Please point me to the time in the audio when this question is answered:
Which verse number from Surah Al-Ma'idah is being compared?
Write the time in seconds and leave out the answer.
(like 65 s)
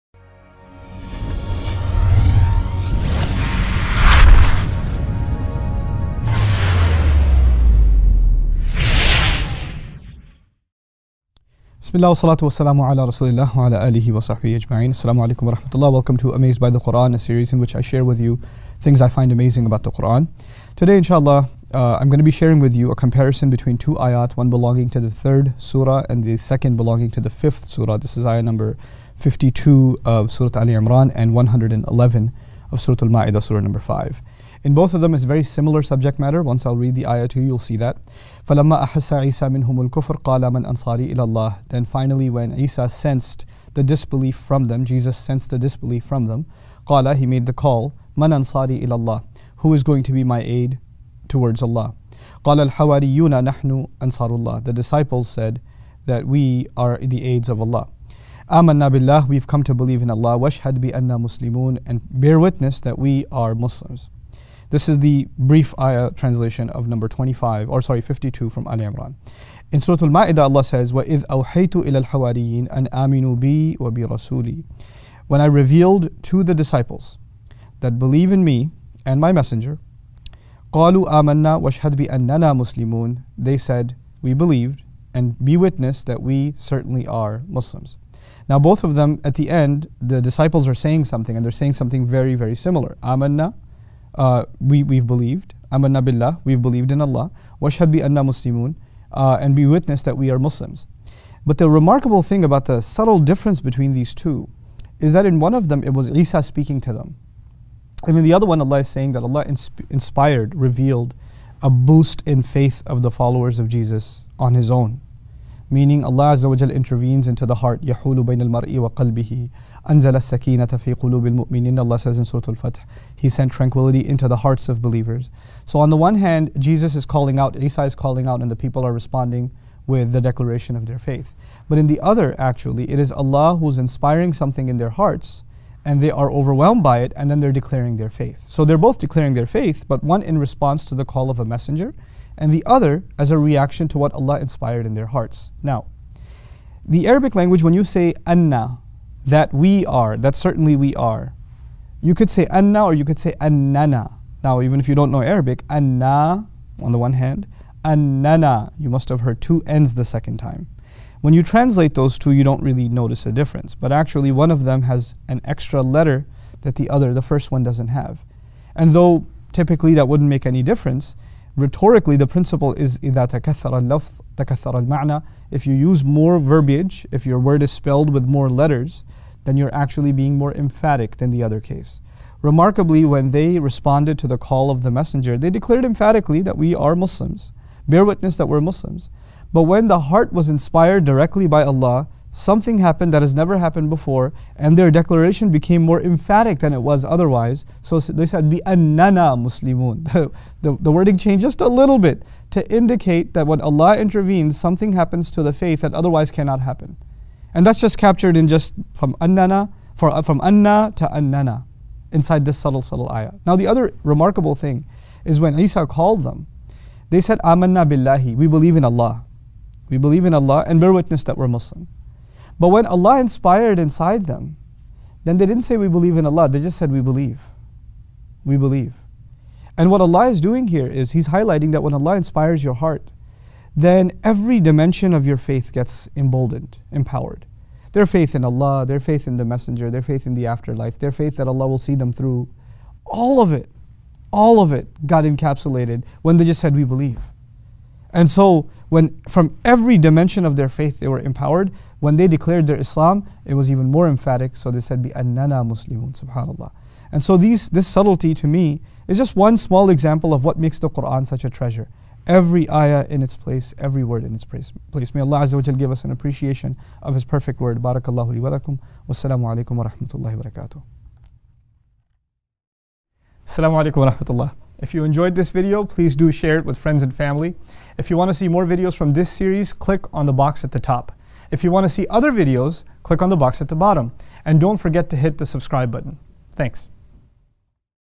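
31 s.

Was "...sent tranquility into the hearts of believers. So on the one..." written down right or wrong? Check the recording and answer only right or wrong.
right.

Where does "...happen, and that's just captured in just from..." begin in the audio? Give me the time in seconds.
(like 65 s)
206 s.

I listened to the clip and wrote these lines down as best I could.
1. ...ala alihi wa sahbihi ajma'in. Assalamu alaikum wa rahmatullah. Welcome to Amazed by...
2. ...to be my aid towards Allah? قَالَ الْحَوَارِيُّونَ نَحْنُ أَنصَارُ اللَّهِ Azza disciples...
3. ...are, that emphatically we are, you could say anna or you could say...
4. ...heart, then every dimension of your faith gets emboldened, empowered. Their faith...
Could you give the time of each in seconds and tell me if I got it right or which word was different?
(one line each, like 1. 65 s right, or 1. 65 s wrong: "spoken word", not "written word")
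1. 13 s right
2. 50 s wrong: "The", not "Azza"
3. 149 s wrong: "certainly", not "emphatically"
4. 232 s right.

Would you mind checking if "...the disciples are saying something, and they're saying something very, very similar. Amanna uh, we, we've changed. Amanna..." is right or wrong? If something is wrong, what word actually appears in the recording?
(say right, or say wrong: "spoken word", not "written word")
wrong: "believed", not "changed".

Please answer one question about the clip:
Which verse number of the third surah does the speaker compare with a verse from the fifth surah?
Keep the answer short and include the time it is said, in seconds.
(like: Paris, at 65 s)
52, at 28 s.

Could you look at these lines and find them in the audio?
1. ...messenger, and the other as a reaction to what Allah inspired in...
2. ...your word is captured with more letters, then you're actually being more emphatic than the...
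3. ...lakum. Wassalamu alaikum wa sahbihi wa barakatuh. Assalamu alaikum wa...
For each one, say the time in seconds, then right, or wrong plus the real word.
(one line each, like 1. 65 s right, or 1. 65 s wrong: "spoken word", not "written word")
1. 141 s right
2. 177 s wrong: "spelled", not "captured"
3. 268 s wrong: "rahmatullahi", not "sahbihi".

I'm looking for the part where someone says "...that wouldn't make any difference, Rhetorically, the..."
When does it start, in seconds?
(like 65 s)
169 s.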